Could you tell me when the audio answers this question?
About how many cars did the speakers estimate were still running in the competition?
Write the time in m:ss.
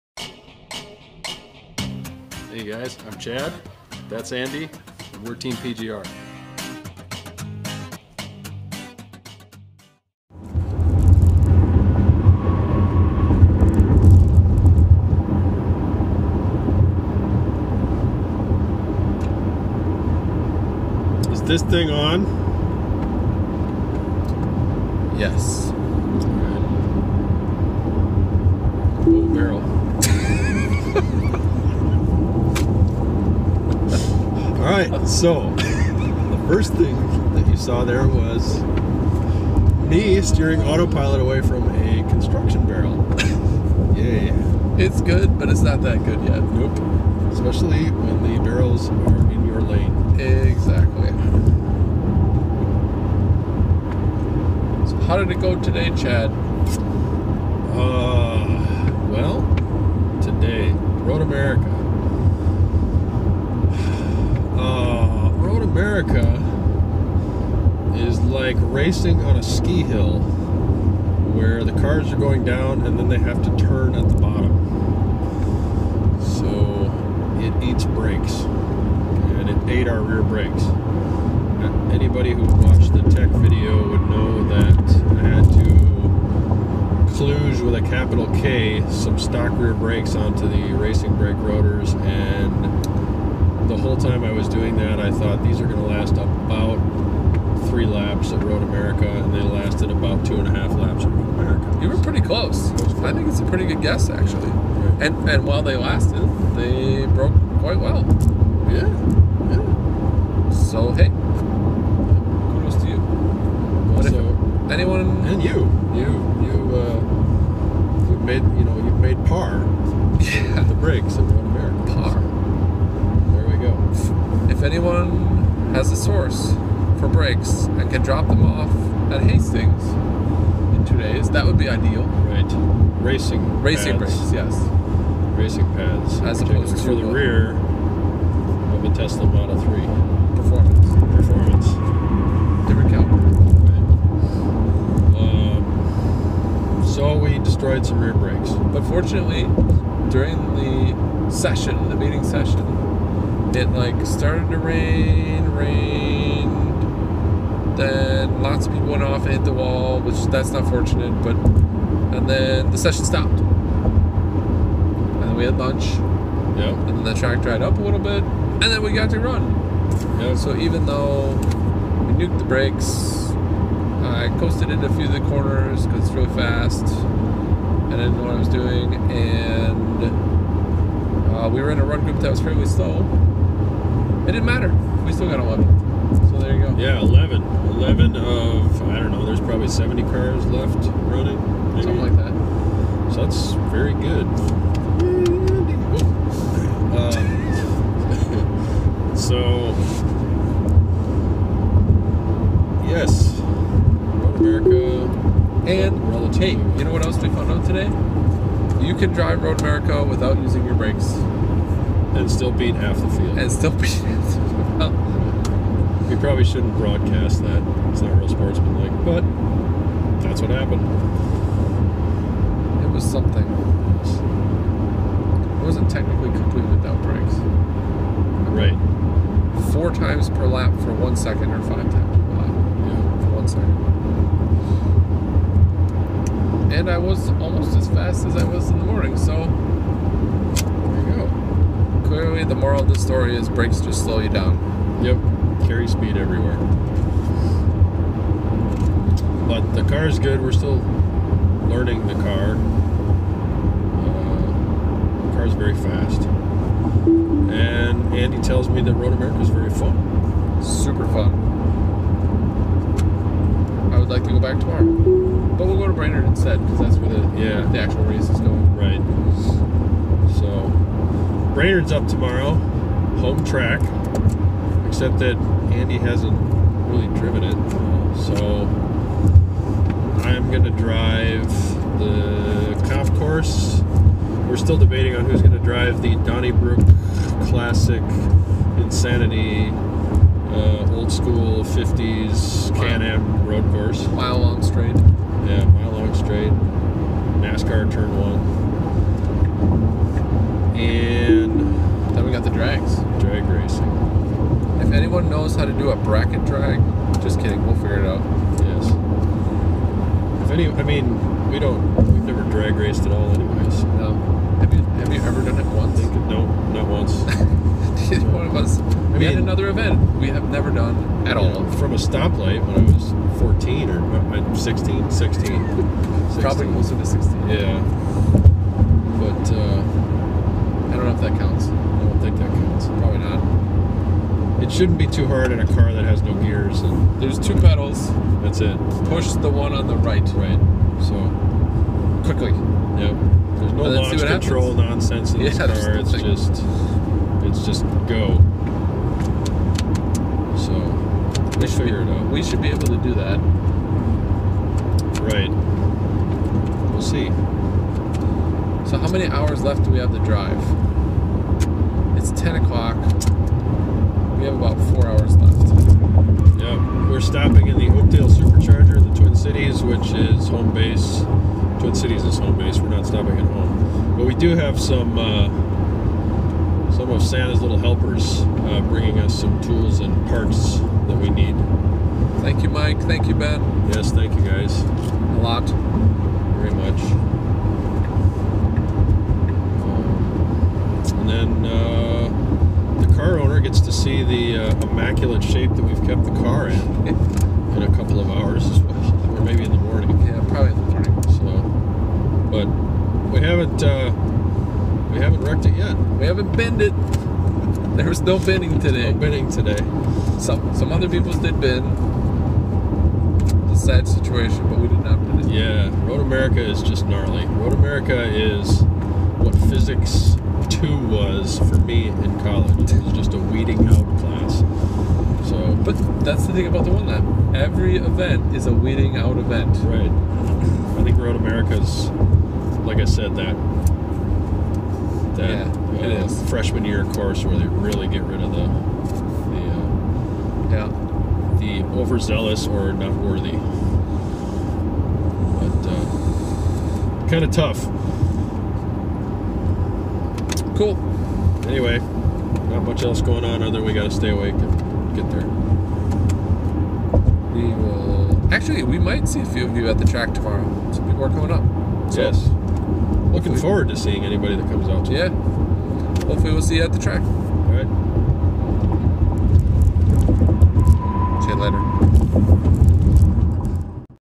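3:09.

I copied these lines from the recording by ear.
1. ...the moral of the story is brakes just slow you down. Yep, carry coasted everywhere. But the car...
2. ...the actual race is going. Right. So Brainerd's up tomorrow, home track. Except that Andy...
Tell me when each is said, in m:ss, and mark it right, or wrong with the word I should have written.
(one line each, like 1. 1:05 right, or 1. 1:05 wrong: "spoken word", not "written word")
1. 4:02 wrong: "speed", not "coasted"
2. 4:27 right.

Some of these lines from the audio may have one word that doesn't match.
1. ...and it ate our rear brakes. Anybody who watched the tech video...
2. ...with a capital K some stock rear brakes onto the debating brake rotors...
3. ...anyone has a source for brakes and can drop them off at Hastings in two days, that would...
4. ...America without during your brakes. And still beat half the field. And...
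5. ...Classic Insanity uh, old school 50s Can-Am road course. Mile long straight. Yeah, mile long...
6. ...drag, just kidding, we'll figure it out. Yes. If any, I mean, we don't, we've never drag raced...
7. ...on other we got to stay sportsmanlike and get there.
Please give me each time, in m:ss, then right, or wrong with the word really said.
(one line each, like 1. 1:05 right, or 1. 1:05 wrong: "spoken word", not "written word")
1. 1:19 right
2. 1:27 wrong: "racing", not "debating"
3. 2:04 right
4. 3:29 wrong: "using", not "during"
5. 4:47 right
6. 5:06 right
7. 7:33 wrong: "awake", not "sportsmanlike".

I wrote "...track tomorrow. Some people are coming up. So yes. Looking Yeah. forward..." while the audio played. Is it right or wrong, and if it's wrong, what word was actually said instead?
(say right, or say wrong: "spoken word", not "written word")
wrong: "Hopefully", not "Yeah".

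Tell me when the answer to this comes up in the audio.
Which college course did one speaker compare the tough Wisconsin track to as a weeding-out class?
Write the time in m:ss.
6:59.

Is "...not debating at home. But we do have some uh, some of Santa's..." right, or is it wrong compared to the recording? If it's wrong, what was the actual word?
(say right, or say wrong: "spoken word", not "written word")
wrong: "stopping", not "debating".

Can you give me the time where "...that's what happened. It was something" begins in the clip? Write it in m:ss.
3:40.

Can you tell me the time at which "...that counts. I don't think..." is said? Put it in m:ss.
5:31.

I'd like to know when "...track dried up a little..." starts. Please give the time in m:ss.
2:47.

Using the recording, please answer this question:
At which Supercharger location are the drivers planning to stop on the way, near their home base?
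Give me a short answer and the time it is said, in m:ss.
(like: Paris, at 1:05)
Oakdale, at 6:07.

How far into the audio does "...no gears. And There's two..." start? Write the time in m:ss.
5:36.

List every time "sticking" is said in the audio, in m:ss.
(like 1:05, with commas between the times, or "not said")
not said.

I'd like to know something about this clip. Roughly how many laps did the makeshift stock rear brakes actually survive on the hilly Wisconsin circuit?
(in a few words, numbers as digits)
2.5 laps.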